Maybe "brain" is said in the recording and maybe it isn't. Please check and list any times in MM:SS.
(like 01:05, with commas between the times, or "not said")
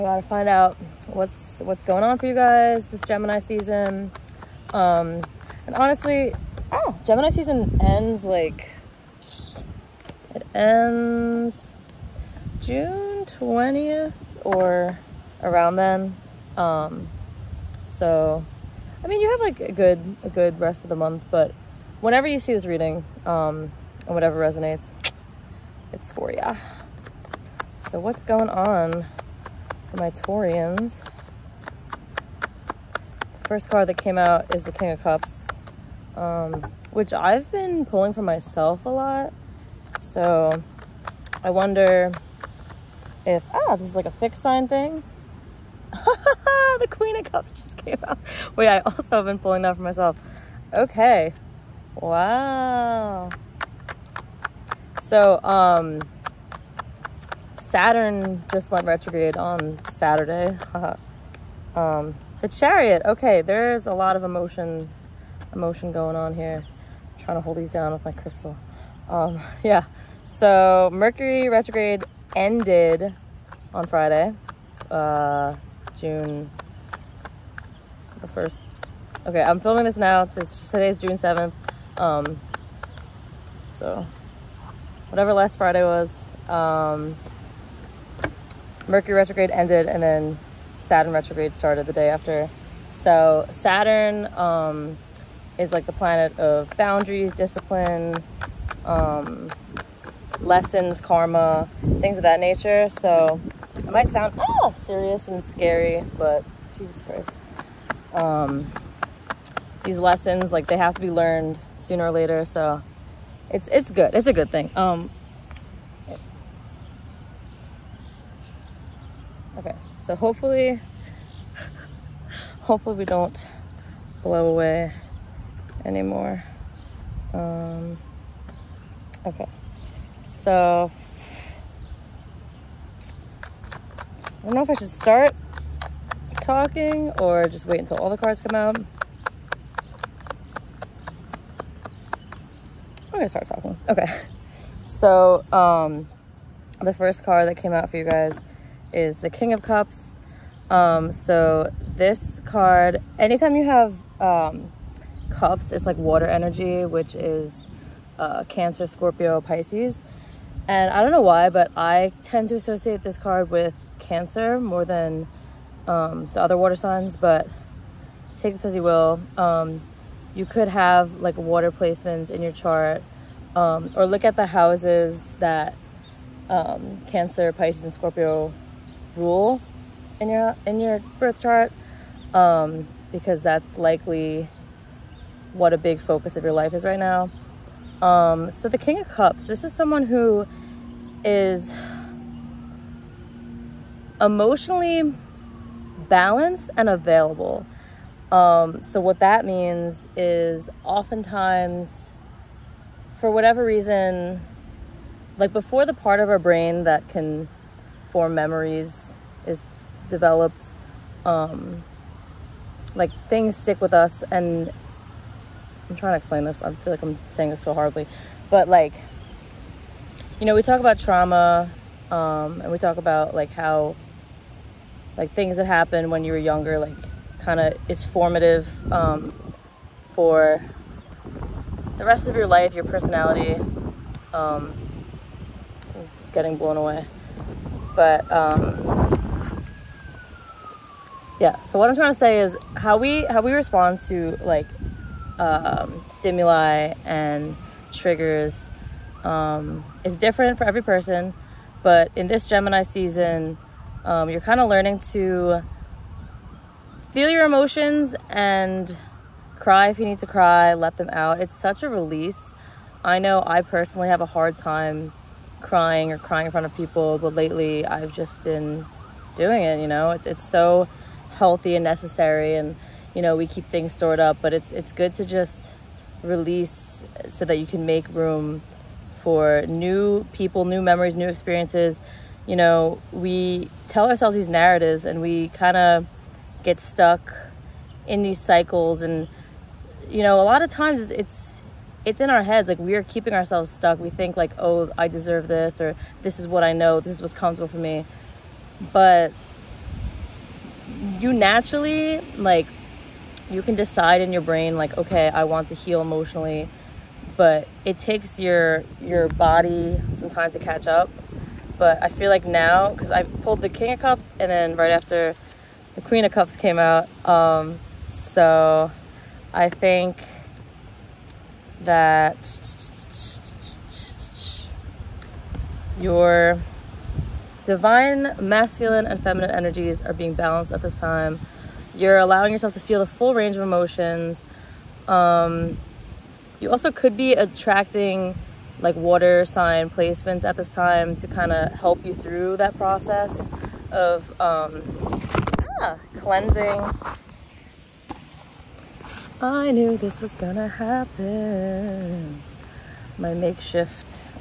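03:26, 05:04.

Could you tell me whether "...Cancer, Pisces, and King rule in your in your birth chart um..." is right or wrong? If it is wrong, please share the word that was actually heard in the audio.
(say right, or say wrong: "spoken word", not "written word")
wrong: "Scorpio", not "King".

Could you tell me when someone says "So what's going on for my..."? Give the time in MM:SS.
00:27.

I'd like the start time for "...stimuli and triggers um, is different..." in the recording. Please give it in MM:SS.
04:06.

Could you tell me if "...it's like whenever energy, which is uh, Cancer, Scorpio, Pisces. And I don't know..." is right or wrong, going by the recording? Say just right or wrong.
wrong.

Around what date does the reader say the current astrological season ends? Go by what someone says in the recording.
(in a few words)
June 20th.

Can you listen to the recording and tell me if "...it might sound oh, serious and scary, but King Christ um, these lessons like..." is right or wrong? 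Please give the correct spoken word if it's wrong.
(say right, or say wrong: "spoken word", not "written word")
wrong: "Jesus", not "King".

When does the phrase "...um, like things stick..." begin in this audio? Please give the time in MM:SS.
03:31.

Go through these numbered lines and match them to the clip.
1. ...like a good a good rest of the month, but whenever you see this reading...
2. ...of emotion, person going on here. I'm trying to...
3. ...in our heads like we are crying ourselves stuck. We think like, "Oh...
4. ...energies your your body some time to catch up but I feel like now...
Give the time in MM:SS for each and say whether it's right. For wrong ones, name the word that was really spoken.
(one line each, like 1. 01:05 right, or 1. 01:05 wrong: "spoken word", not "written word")
1. 00:19 right
2. 01:04 wrong: "emotion", not "person"
3. 04:52 wrong: "keeping", not "crying"
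4. 05:07 wrong: "takes", not "energies".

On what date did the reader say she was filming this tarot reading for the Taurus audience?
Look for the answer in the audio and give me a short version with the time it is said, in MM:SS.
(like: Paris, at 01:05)
June 7th, at 01:20.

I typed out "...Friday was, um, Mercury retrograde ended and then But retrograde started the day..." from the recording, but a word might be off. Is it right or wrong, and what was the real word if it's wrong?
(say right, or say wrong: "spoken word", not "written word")
wrong: "Saturn", not "But".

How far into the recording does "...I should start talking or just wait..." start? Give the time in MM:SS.
02:14.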